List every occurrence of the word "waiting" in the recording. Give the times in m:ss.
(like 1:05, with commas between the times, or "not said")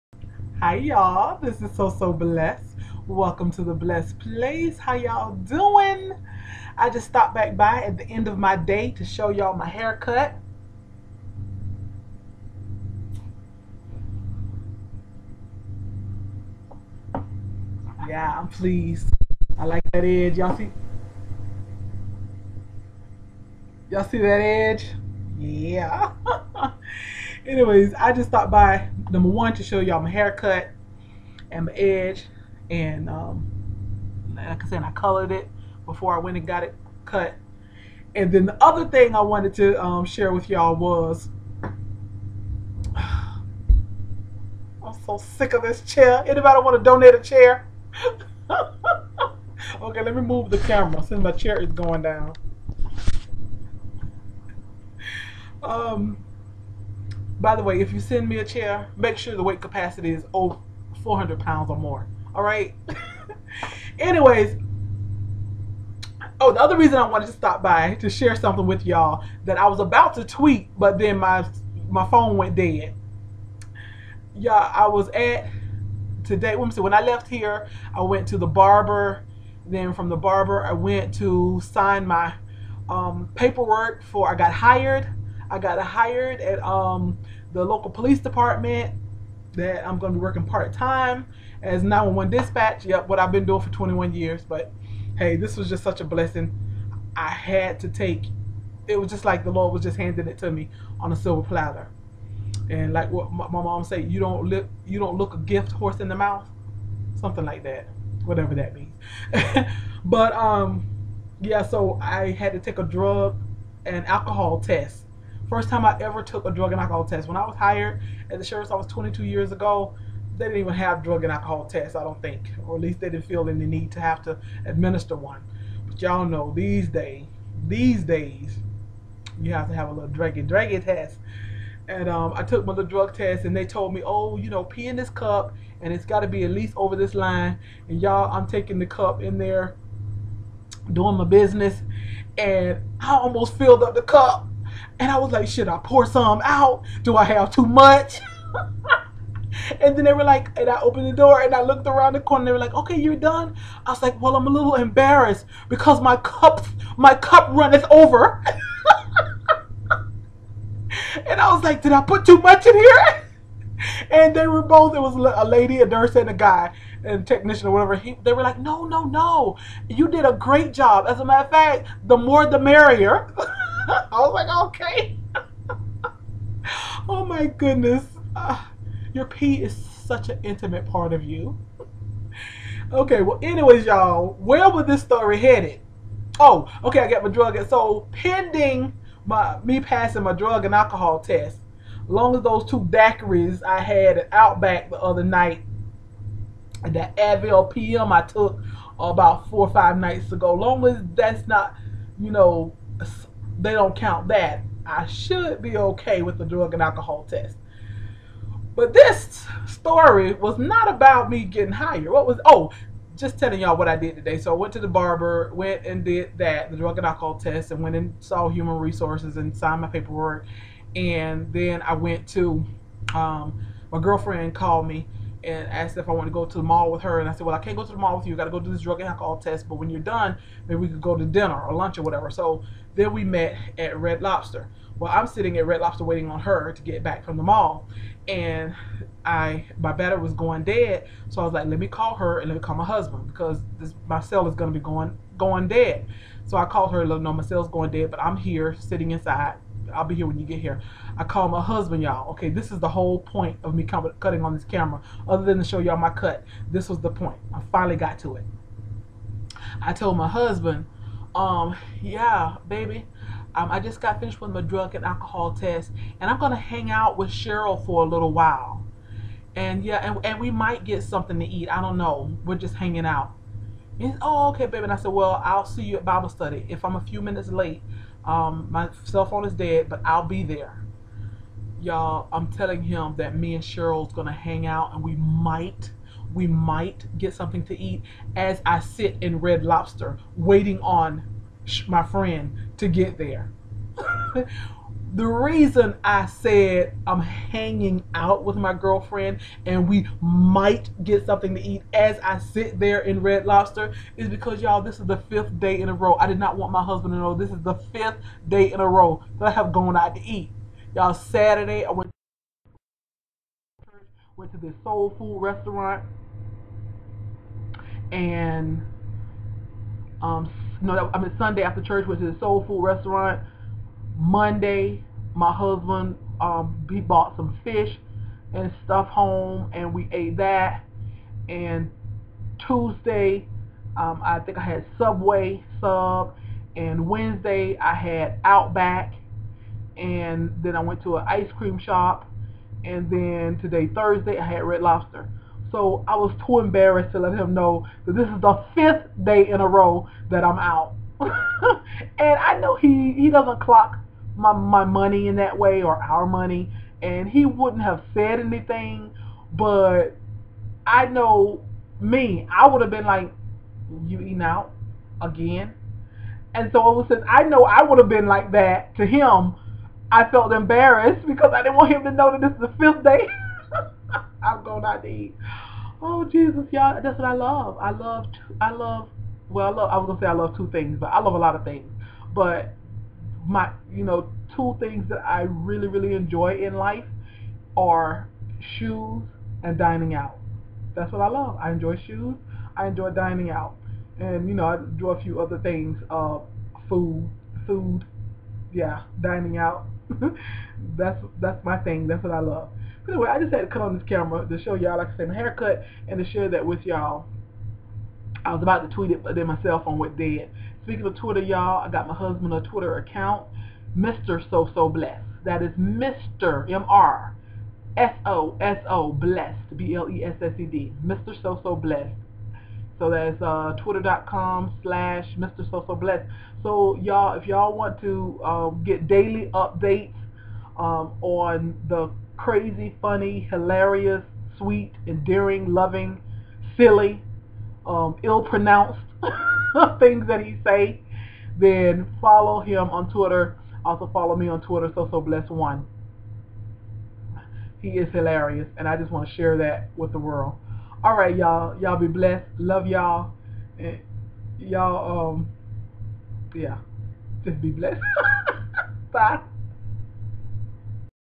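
3:56, 4:50.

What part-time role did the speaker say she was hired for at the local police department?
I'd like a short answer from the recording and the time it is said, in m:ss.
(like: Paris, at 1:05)
911 dispatch, at 1:31.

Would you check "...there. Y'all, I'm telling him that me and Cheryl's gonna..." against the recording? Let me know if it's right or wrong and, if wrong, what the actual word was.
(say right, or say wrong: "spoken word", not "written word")
right.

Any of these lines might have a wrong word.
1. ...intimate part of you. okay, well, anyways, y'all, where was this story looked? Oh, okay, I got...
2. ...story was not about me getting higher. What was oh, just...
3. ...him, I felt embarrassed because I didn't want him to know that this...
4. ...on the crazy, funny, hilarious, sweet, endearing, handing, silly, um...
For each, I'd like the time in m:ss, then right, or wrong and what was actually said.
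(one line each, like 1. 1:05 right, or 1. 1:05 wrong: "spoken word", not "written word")
1. 3:00 wrong: "headed", not "looked"
2. 3:29 right
3. 6:09 right
4. 7:11 wrong: "loving", not "handing".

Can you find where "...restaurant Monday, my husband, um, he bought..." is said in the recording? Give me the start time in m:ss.
5:22.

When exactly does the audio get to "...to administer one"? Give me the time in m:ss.
2:04.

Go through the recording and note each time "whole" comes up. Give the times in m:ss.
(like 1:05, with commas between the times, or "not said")
4:12.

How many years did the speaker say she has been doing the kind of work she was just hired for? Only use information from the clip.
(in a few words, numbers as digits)
21.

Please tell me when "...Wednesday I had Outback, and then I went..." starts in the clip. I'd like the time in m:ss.
5:37.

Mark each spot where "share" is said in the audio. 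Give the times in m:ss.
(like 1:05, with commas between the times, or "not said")
0:40, 1:08, 6:46, 7:29.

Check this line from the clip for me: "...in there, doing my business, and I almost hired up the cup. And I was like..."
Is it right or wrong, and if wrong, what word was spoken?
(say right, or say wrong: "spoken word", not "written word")
wrong: "filled", not "hired".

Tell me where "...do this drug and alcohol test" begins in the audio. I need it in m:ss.
3:48.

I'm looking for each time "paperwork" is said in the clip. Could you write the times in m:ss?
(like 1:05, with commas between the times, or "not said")
1:23, 3:39.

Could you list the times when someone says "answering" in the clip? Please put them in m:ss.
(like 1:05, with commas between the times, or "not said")
not said.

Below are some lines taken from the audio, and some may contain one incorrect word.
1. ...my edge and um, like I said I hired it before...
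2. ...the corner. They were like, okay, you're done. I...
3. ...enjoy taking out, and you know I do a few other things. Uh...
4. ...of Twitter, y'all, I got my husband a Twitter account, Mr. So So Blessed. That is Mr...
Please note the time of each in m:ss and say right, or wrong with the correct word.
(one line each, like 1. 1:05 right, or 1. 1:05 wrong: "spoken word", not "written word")
1. 0:31 wrong: "colored", not "hired"
2. 2:32 right
3. 6:32 wrong: "dining", not "taking"
4. 6:51 right.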